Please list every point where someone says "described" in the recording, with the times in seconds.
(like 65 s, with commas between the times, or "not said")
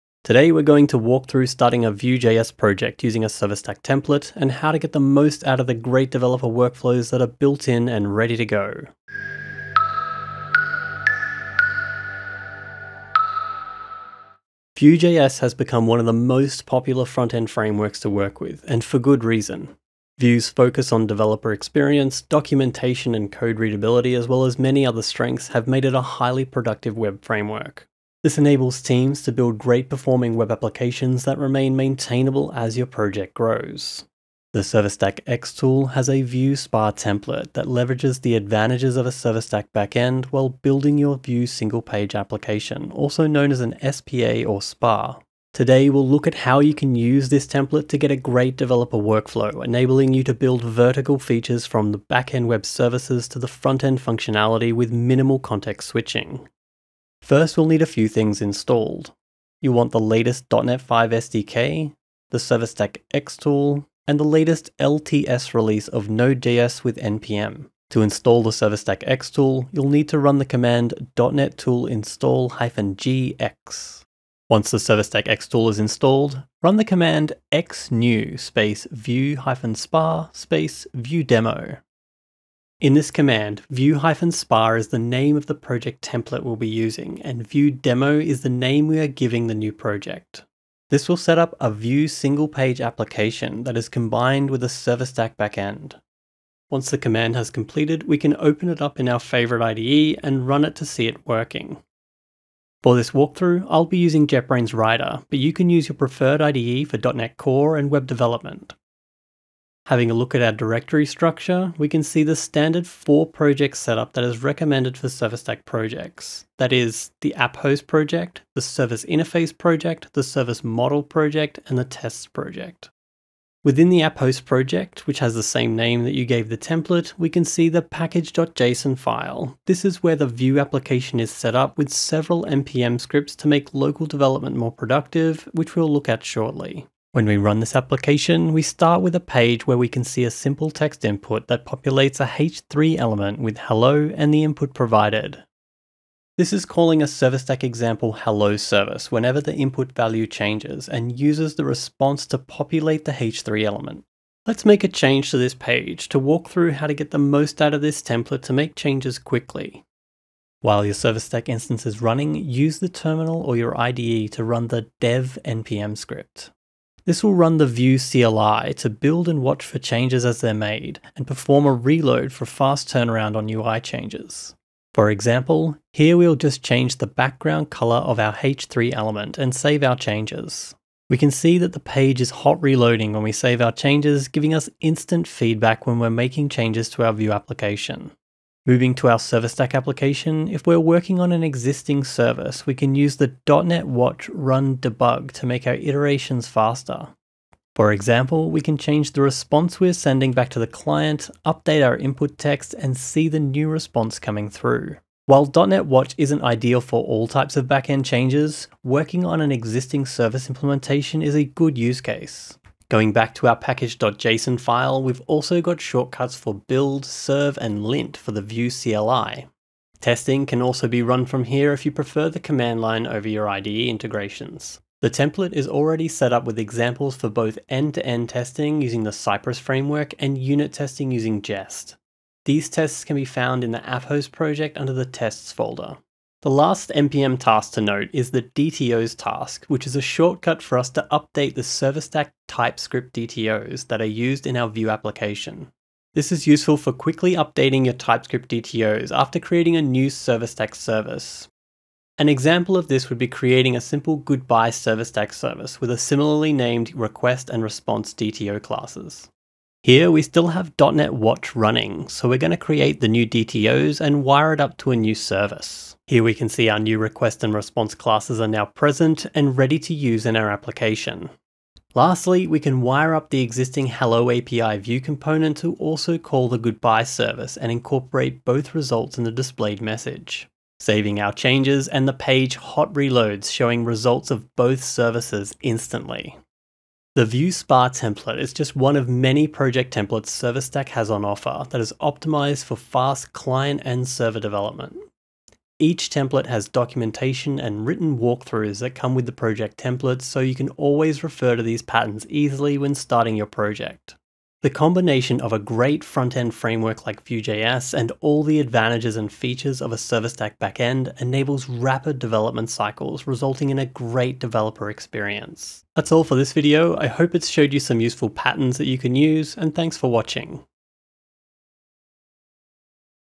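not said.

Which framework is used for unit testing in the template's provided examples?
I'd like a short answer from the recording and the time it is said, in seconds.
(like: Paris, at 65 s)
Jest, at 231 s.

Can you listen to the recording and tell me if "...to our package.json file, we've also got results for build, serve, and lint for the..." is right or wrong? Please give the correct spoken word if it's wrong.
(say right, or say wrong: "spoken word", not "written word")
wrong: "shortcuts", not "results".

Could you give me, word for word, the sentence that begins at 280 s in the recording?
Saving our changes and the page hot reloads showing results of both services instantly.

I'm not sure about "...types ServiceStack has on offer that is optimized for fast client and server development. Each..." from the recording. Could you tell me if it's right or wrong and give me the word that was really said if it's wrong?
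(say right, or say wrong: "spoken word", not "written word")
wrong: "templates", not "types".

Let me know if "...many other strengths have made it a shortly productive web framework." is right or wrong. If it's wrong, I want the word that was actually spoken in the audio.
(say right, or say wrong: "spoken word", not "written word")
wrong: "highly", not "shortly".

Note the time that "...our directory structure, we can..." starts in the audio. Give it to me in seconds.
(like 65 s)
110 s.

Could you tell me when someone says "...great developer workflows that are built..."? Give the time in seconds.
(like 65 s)
5 s.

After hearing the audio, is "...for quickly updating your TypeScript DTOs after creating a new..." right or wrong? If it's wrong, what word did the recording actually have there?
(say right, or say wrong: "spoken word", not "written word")
right.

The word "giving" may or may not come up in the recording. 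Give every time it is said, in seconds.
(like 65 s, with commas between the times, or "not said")
89 s, 184 s.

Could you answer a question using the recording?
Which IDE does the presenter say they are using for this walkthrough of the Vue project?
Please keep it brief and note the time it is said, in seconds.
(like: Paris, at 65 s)
JetBrains Rider, at 104 s.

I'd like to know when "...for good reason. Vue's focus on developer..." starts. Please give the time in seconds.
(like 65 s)
18 s.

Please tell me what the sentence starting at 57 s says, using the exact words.
First, we'll need a few things installed.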